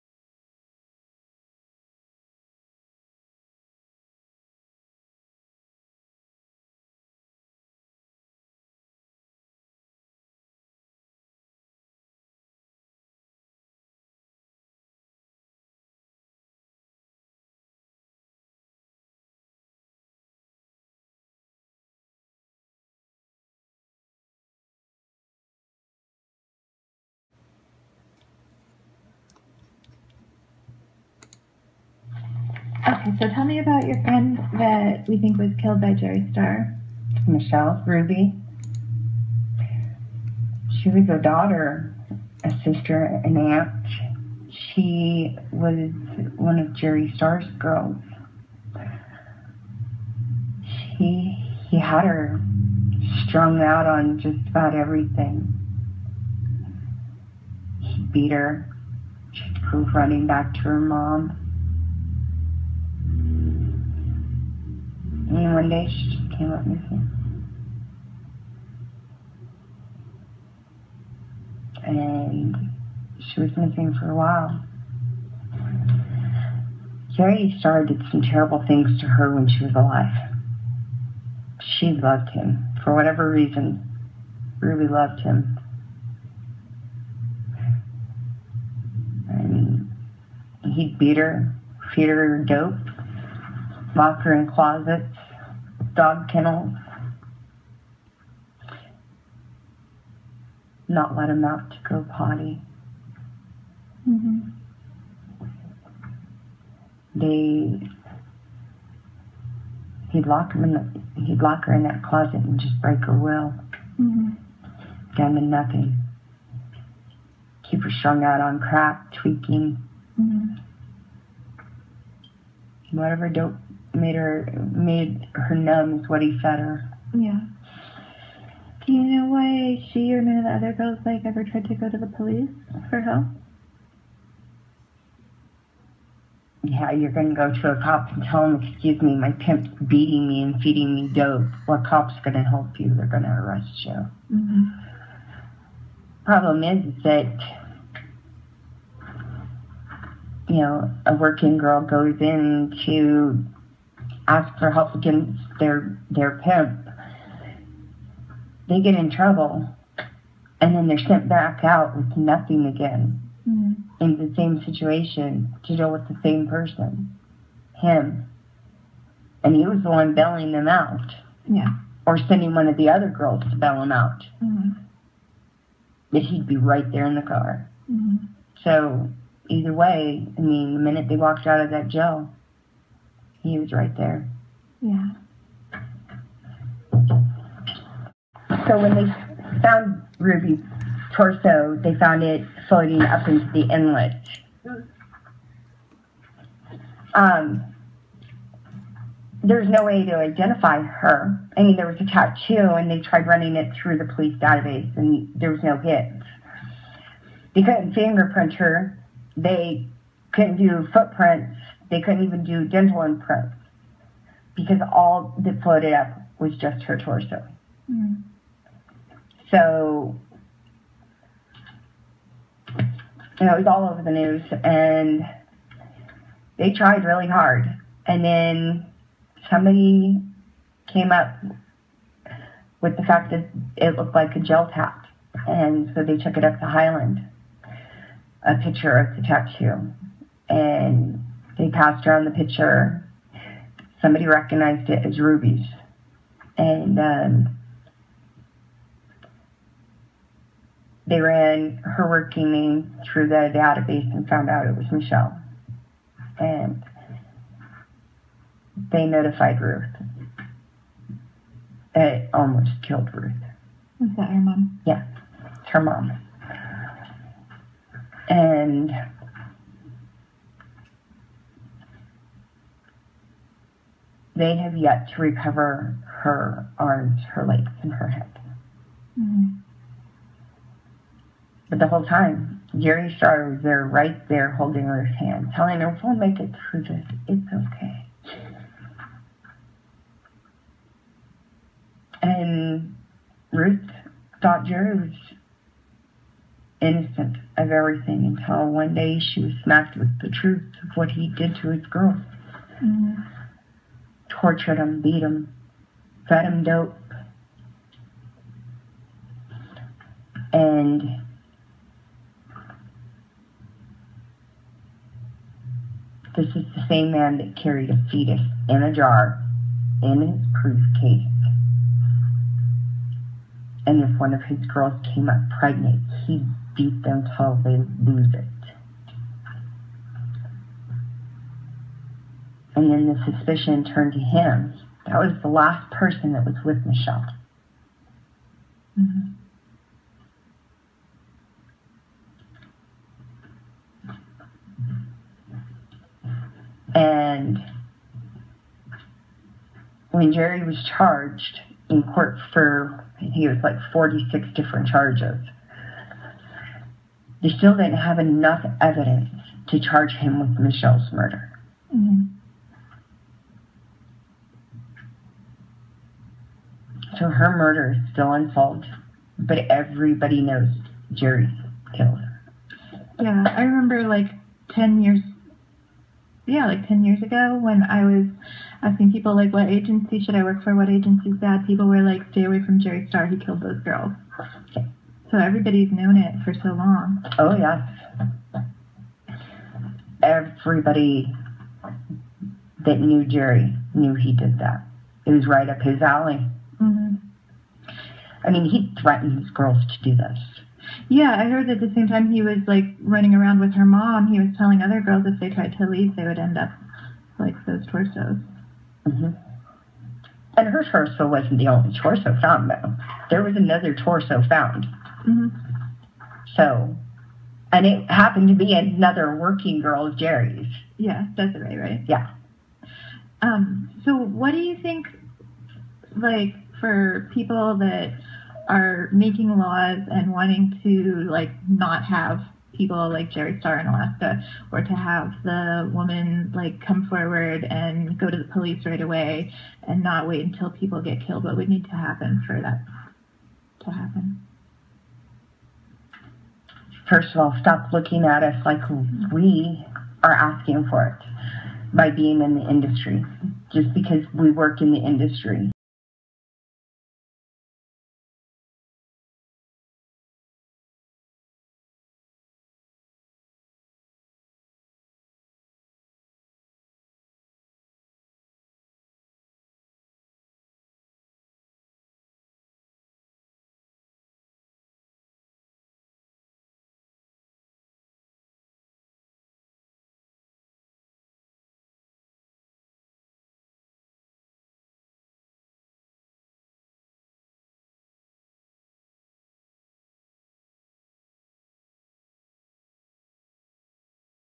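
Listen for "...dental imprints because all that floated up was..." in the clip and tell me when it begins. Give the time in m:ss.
3:32.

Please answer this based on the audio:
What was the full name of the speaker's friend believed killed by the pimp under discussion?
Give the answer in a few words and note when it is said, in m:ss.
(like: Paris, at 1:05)
Michelle Ruby, at 0:37.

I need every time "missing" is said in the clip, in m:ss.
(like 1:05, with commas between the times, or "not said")
1:06, 1:13.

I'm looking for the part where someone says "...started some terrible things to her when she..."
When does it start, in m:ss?
1:17.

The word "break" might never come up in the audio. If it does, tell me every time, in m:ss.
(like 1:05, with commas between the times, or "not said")
1:52.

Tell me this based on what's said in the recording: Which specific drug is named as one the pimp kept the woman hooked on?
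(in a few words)
Crack.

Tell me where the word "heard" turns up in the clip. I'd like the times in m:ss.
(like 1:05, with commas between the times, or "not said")
6:41.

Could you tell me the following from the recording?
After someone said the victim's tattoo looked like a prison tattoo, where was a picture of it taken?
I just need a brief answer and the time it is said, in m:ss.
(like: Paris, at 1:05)
Hiland, at 3:56.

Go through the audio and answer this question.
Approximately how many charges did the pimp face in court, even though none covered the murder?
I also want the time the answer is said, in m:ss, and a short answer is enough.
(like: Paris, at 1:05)
46, at 5:53.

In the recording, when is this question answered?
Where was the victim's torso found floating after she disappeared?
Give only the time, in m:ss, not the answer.
3:13.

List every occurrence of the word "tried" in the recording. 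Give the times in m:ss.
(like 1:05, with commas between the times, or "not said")
2:11, 3:23, 3:46, 6:45.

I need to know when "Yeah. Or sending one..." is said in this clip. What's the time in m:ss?
2:51.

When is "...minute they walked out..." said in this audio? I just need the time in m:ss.
3:00.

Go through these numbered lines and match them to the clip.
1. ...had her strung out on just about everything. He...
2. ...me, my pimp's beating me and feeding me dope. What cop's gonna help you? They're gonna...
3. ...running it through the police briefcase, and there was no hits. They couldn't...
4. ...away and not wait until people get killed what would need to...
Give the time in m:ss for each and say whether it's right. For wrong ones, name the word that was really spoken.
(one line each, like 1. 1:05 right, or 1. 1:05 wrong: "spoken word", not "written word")
1. 0:51 right
2. 2:19 right
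3. 3:23 wrong: "database", not "briefcase"
4. 7:19 right.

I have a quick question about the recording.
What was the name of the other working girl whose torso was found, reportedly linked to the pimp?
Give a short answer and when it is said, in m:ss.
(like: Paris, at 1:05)
Desiree, at 7:01.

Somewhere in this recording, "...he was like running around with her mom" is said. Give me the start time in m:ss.
6:42.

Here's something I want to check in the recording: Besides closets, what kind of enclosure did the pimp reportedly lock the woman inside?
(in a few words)
Dog kennels.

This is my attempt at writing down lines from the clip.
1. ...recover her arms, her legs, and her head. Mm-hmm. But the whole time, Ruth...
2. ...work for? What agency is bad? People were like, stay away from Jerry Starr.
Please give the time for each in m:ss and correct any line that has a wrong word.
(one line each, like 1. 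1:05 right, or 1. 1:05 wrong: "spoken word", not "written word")
1. 4:35 wrong: "Jerry", not "Ruth"
2. 6:20 right.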